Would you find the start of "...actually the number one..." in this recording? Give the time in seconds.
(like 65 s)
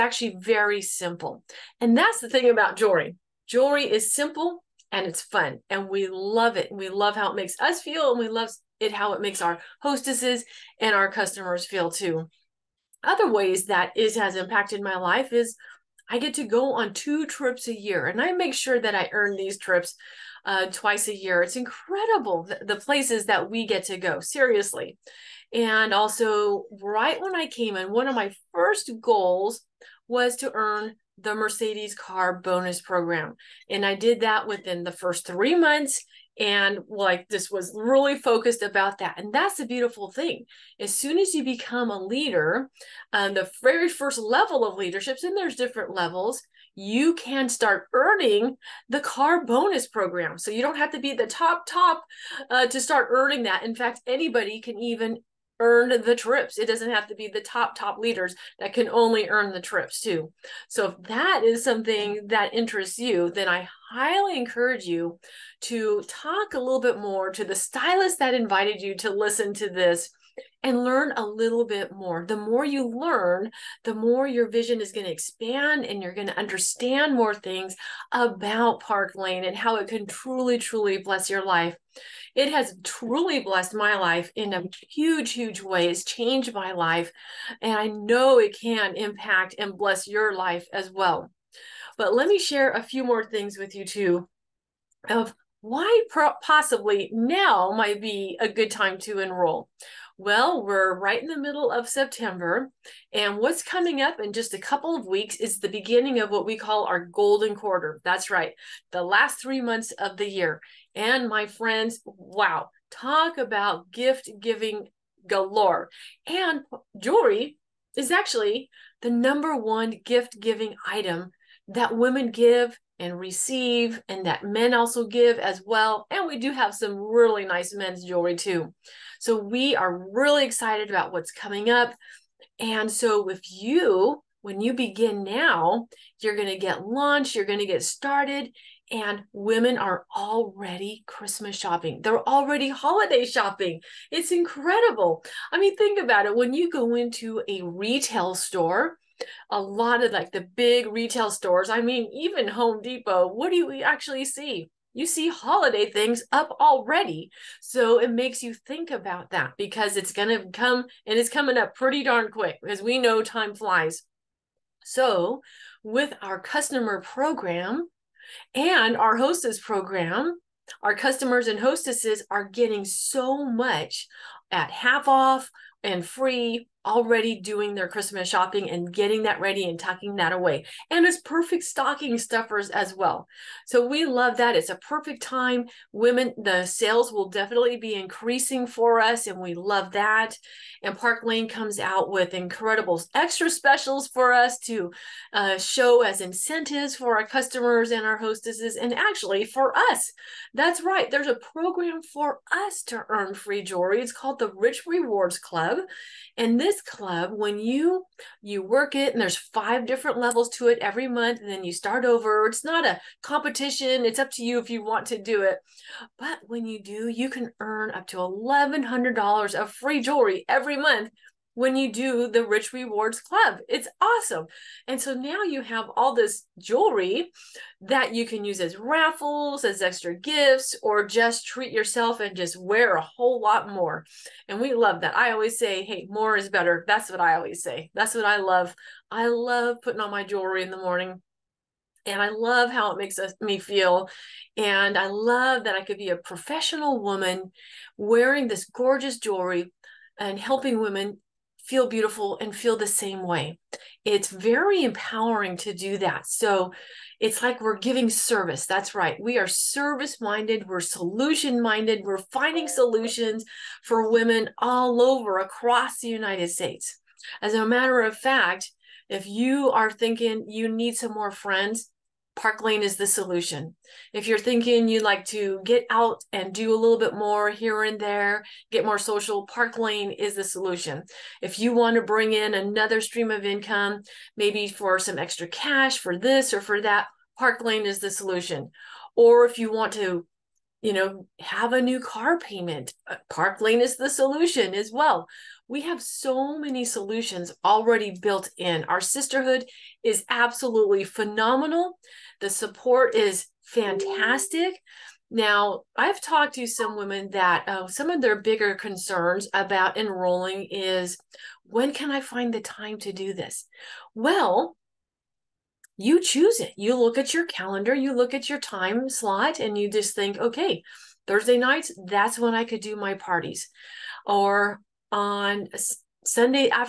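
118 s.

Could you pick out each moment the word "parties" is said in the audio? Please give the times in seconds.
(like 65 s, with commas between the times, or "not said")
323 s.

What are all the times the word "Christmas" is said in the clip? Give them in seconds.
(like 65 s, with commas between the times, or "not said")
141 s, 177 s.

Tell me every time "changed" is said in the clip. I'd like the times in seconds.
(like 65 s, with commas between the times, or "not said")
86 s.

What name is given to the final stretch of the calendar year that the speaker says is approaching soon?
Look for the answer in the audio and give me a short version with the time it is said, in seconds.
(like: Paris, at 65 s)
Golden quarter, at 107 s.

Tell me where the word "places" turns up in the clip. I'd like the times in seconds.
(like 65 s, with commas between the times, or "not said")
22 s.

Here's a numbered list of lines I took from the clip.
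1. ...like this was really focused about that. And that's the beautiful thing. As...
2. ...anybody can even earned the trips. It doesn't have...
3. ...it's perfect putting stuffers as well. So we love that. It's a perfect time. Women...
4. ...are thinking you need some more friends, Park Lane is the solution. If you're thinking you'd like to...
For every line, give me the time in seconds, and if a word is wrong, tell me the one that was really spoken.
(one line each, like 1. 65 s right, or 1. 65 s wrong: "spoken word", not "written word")
1. 36 s right
2. 54 s right
3. 181 s wrong: "stocking", not "putting"
4. 269 s right.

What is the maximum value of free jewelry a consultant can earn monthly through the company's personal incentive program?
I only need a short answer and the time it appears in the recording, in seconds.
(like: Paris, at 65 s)
$1,100, at 218 s.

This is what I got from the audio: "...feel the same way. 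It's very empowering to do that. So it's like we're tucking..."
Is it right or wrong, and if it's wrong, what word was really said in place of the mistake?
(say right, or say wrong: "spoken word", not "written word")
wrong: "giving", not "tucking".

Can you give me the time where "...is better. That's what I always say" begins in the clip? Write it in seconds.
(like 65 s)
236 s.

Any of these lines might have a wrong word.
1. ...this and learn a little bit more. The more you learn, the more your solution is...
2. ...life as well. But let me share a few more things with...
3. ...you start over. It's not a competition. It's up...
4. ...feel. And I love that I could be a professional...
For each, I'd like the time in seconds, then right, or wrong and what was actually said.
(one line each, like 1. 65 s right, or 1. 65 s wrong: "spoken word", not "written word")
1. 69 s wrong: "vision", not "solution"
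2. 90 s right
3. 211 s right
4. 243 s right.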